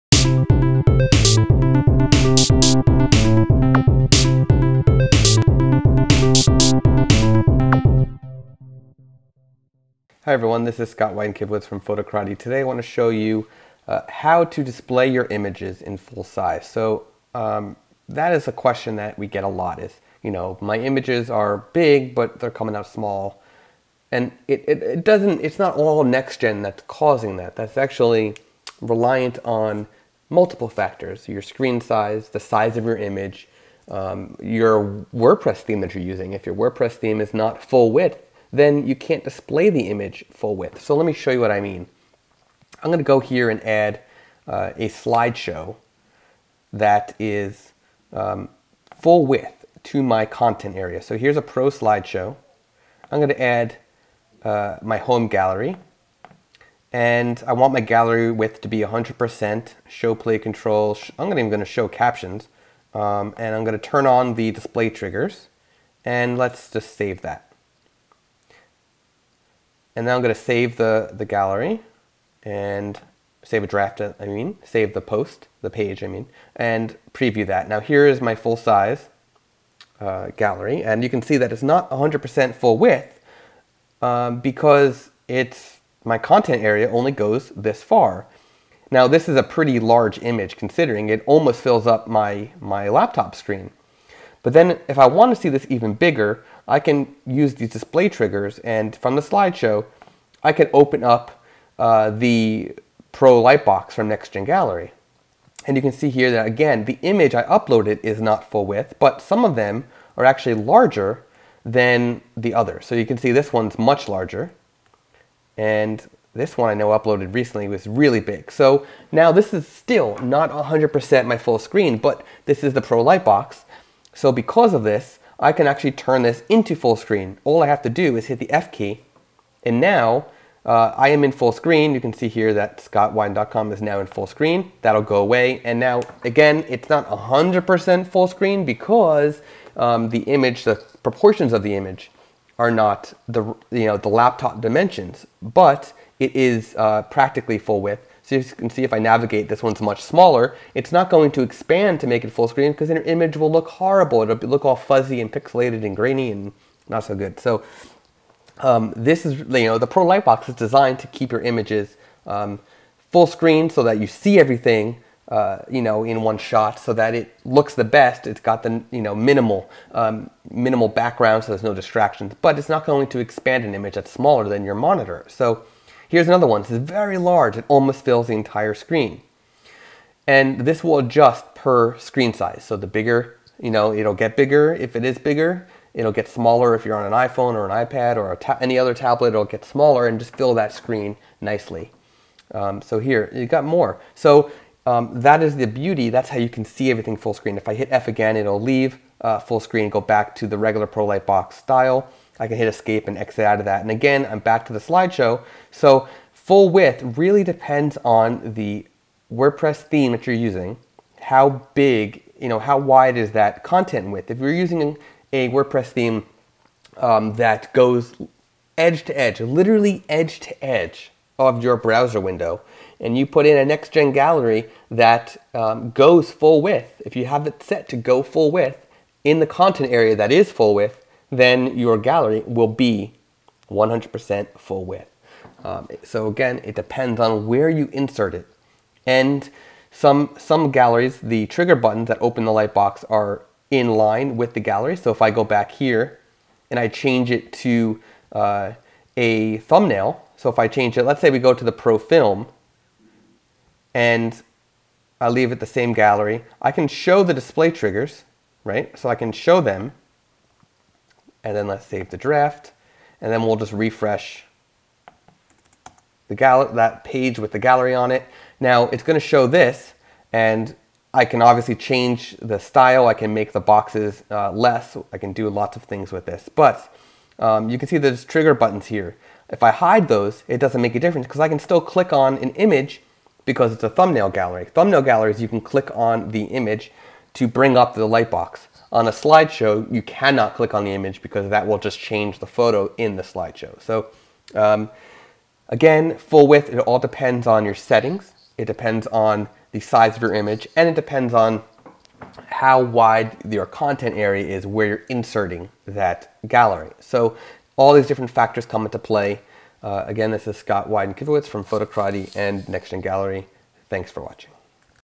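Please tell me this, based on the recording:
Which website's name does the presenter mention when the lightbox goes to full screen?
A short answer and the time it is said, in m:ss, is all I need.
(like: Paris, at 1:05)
scottwyden.com, at 2:12.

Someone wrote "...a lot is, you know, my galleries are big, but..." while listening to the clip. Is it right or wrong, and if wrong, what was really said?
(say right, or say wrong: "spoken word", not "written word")
wrong: "images", not "galleries".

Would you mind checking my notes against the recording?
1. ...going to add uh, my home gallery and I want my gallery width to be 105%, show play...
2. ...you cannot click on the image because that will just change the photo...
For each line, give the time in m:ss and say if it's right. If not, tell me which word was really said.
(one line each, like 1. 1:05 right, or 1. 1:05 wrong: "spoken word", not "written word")
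1. 0:53 wrong: "100", not "105"
2. 4:49 right.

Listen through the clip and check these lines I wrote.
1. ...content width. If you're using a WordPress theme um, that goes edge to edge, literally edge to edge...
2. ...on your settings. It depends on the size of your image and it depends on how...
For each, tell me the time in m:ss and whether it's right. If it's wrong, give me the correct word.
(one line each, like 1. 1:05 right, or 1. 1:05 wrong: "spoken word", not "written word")
1. 3:33 right
2. 4:57 right.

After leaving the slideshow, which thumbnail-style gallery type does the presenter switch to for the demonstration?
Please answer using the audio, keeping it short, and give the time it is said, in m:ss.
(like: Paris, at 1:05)
Pro Film, at 4:11.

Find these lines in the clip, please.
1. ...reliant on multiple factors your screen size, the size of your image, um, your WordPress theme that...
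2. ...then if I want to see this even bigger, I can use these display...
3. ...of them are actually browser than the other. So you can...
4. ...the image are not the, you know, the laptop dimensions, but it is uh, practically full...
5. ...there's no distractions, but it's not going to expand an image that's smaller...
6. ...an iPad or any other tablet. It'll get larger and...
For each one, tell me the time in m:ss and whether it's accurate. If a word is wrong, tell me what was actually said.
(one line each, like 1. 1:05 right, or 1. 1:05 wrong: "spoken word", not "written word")
1. 0:28 right
2. 1:34 right
3. 1:49 wrong: "larger", not "browser"
4. 2:21 right
5. 2:51 right
6. 3:07 wrong: "smaller", not "larger".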